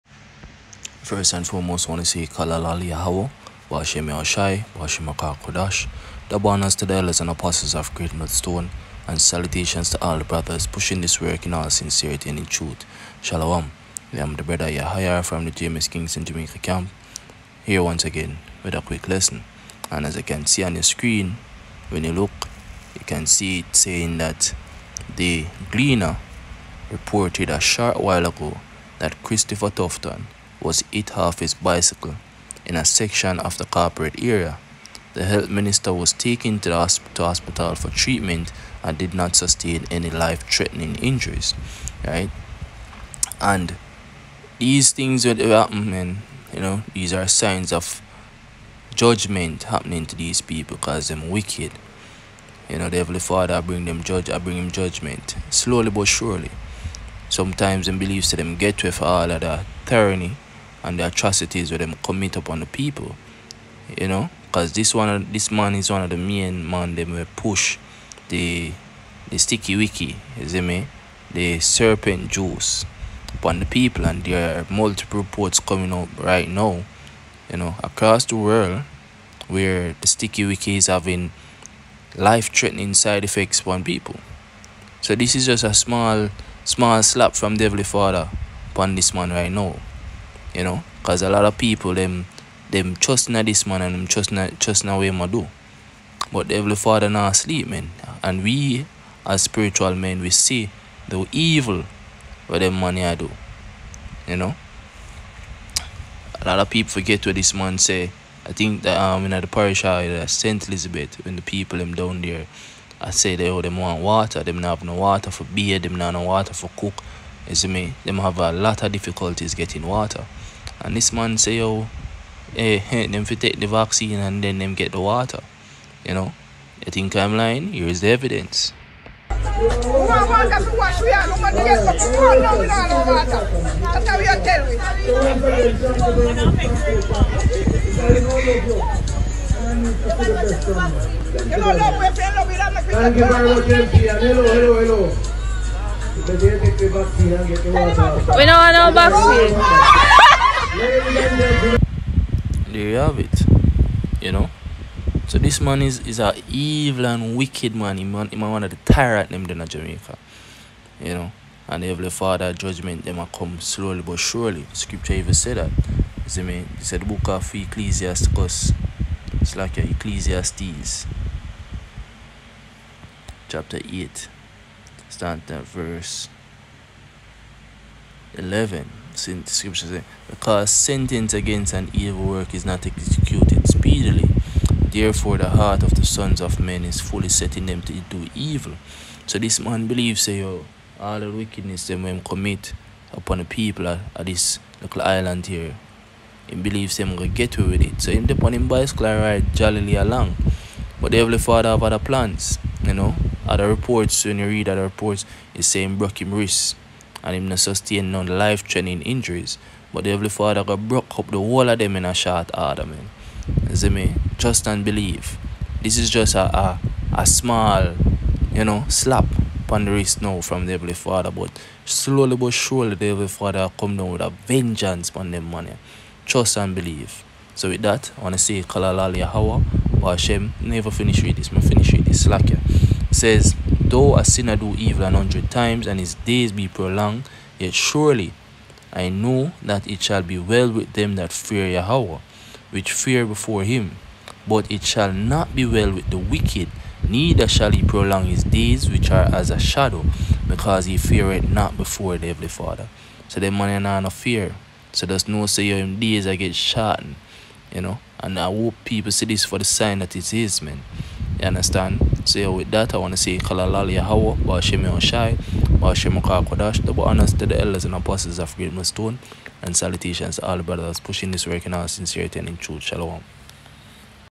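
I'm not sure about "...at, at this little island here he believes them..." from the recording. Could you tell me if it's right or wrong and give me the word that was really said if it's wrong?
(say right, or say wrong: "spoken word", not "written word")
right.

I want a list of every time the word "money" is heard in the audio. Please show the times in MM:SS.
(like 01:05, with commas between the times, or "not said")
01:42, 03:45.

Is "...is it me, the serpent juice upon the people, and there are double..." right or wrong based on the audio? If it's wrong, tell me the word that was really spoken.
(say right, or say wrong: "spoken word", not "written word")
wrong: "multiple", not "double".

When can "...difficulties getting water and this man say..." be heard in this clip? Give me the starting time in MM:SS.
01:58.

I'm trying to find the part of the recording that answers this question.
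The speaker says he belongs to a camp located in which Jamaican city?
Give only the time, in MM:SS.
00:15.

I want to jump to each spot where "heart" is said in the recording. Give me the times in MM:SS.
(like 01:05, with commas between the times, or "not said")
03:05.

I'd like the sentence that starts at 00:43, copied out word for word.
And these things that happen, you know, these are signs of judgment happening to these people because they're wicked.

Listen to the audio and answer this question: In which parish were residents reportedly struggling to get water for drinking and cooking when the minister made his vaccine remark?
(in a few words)
Saint Elizabeth.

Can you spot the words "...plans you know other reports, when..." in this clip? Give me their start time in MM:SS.
03:21.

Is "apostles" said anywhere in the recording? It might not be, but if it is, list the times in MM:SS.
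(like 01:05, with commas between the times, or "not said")
00:07, 04:27.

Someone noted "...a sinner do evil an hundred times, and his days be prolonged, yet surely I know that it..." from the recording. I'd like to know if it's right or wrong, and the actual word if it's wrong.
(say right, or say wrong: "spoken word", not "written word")
right.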